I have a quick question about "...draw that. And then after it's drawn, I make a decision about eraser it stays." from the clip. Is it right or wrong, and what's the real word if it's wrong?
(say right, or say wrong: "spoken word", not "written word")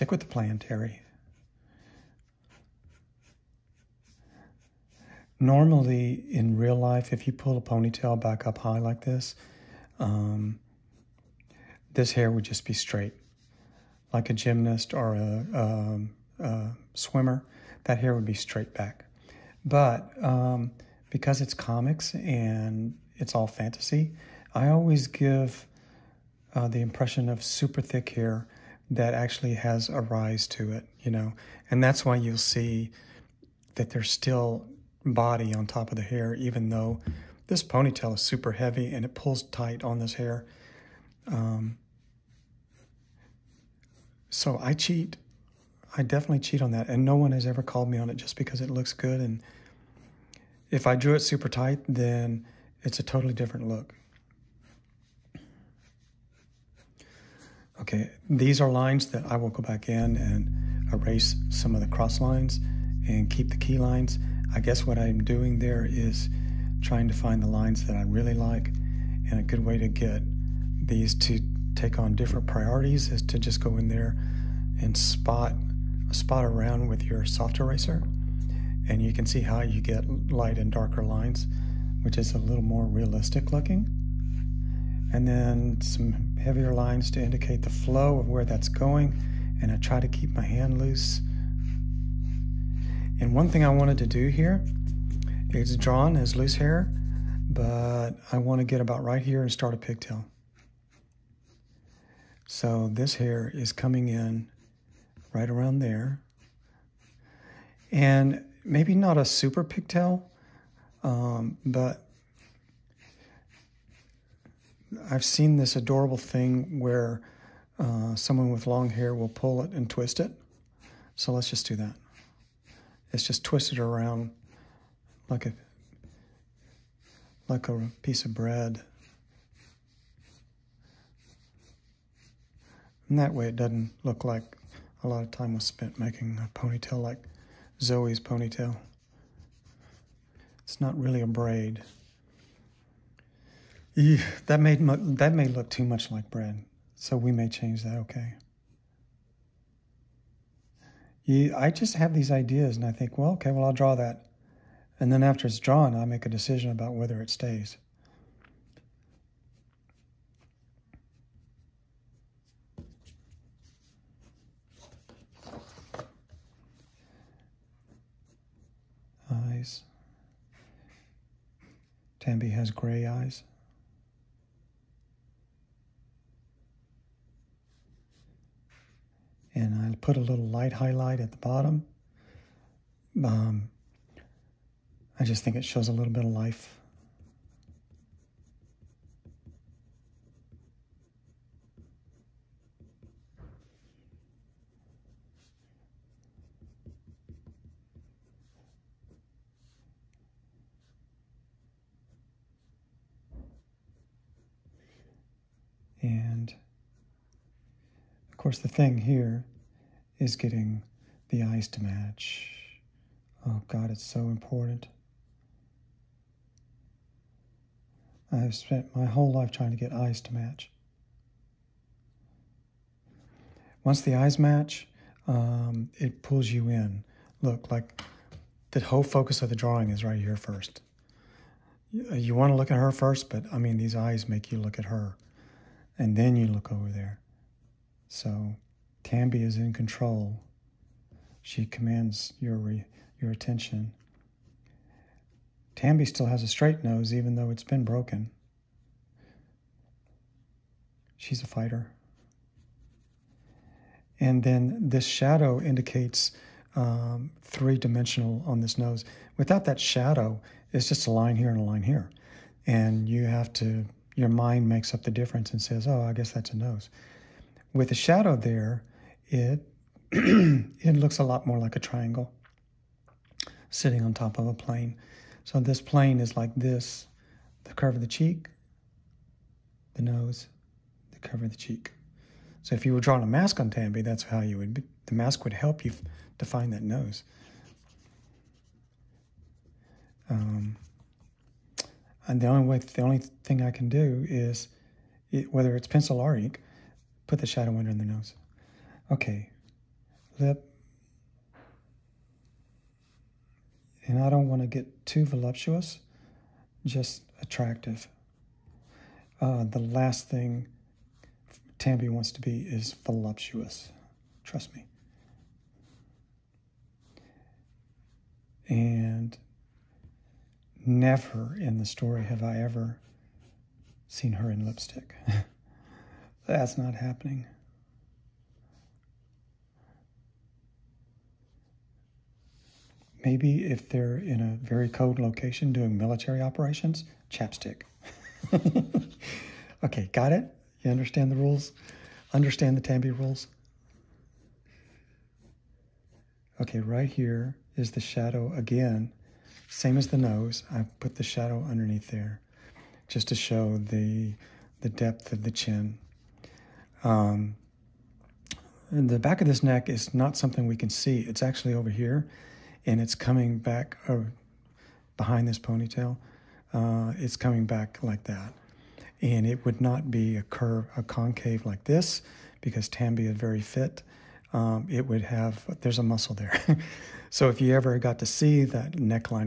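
wrong: "whether", not "eraser".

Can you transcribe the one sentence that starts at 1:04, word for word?
I guess what I'm doing there is trying to find the lines that I really like.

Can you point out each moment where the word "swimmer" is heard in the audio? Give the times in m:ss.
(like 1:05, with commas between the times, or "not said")
0:16.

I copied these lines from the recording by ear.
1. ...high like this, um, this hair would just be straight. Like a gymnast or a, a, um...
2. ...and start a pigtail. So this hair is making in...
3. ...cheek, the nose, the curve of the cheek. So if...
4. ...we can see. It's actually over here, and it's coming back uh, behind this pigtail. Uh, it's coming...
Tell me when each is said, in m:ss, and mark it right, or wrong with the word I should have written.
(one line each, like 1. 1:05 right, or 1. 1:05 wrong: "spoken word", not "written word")
1. 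0:08 right
2. 1:39 wrong: "coming", not "making"
3. 4:38 right
4. 6:00 wrong: "ponytail", not "pigtail".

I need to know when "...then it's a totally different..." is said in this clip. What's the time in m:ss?
0:51.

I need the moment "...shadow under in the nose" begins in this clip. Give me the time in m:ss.
4:57.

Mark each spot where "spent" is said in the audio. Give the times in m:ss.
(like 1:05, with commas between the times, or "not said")
2:15, 3:38.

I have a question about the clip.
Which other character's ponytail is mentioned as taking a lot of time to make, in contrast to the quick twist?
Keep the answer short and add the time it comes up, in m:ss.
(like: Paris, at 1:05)
Zoe, at 2:17.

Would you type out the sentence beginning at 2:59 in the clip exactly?
and I'll put a little light highlight at the bottom.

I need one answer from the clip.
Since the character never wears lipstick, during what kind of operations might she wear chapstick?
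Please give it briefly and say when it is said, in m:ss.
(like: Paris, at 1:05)
Military operations, at 5:35.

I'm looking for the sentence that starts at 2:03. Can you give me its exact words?
It's just twisted around like a like a piece of bread.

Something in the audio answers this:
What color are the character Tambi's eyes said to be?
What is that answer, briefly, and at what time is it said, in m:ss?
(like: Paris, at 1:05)
Gray, at 2:52.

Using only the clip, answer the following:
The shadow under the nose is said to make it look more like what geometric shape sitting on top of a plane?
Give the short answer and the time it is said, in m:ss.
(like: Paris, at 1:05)
A triangle, at 4:31.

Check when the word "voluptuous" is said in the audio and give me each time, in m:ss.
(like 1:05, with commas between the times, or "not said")
5:05, 5:13.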